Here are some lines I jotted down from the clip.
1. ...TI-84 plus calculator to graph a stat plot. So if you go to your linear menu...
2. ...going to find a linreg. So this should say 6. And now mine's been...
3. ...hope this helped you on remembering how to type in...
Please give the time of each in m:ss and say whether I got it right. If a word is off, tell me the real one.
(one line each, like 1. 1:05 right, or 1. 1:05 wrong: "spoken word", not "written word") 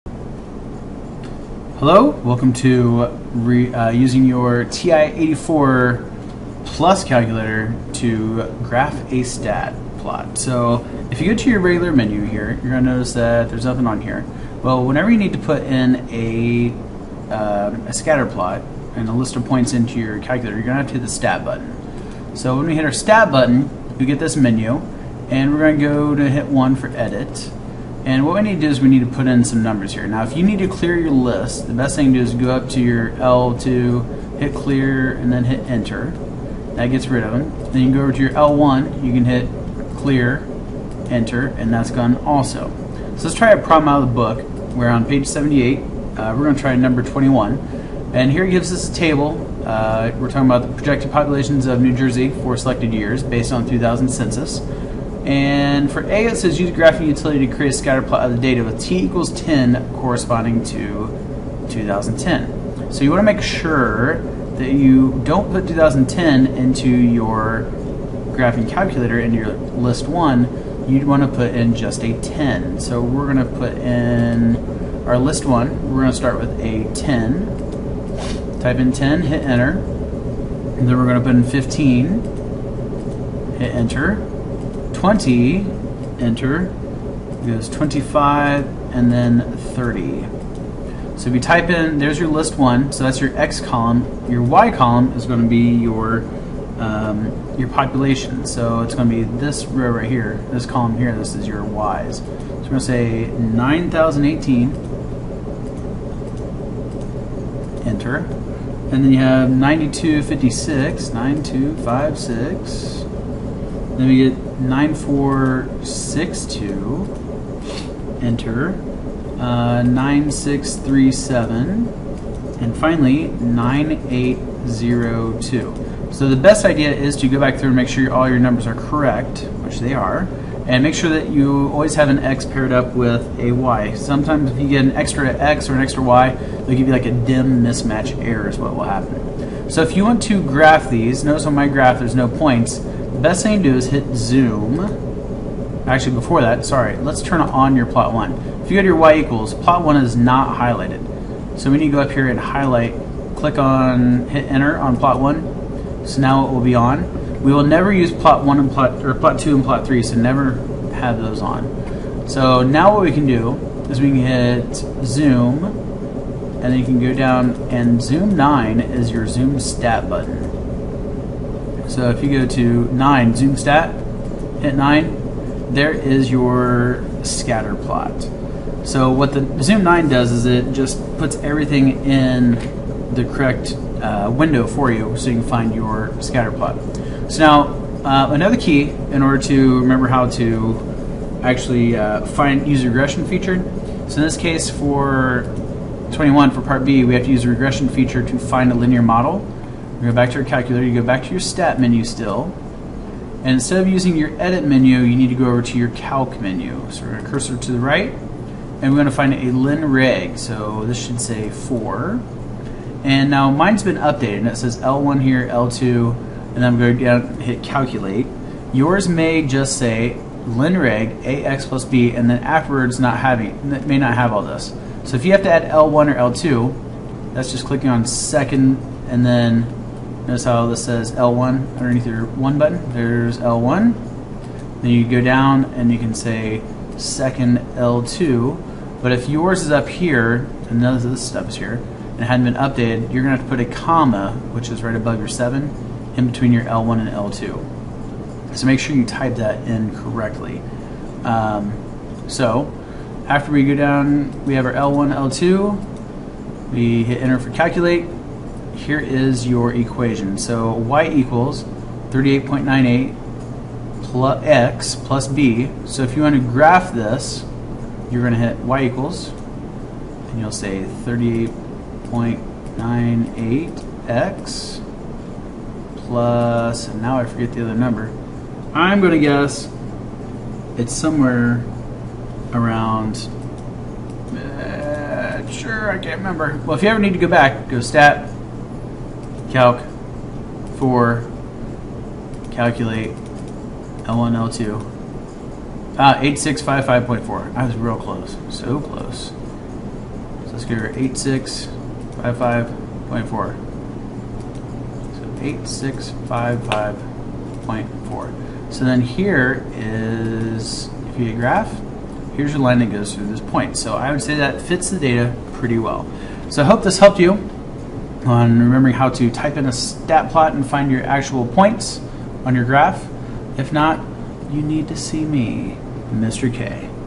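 1. 0:04 wrong: "regular", not "linear"
2. 3:28 wrong: "4", not "6"
3. 5:16 right.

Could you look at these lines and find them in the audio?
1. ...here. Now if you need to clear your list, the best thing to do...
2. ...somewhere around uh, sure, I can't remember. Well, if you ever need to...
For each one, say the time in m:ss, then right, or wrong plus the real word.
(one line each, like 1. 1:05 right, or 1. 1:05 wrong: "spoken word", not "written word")
1. 0:29 right
2. 4:40 right.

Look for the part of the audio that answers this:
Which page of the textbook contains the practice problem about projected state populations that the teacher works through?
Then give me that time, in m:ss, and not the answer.
0:45.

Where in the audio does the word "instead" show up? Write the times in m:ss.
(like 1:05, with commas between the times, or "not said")
3:23.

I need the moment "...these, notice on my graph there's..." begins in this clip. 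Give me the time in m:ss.
2:20.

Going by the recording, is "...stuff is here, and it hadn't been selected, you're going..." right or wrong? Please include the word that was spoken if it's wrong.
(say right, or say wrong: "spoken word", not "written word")
wrong: "updated", not "selected".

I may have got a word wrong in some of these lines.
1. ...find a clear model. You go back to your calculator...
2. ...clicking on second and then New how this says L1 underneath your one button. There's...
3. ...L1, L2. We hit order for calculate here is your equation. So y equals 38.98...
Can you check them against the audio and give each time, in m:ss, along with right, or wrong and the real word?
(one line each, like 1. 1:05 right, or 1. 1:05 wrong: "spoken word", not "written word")
1. 3:18 wrong: "linear", not "clear"
2. 3:47 wrong: "Notice", not "New"
3. 4:14 wrong: "enter", not "order".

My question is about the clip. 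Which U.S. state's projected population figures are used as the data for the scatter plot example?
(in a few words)
New Jersey.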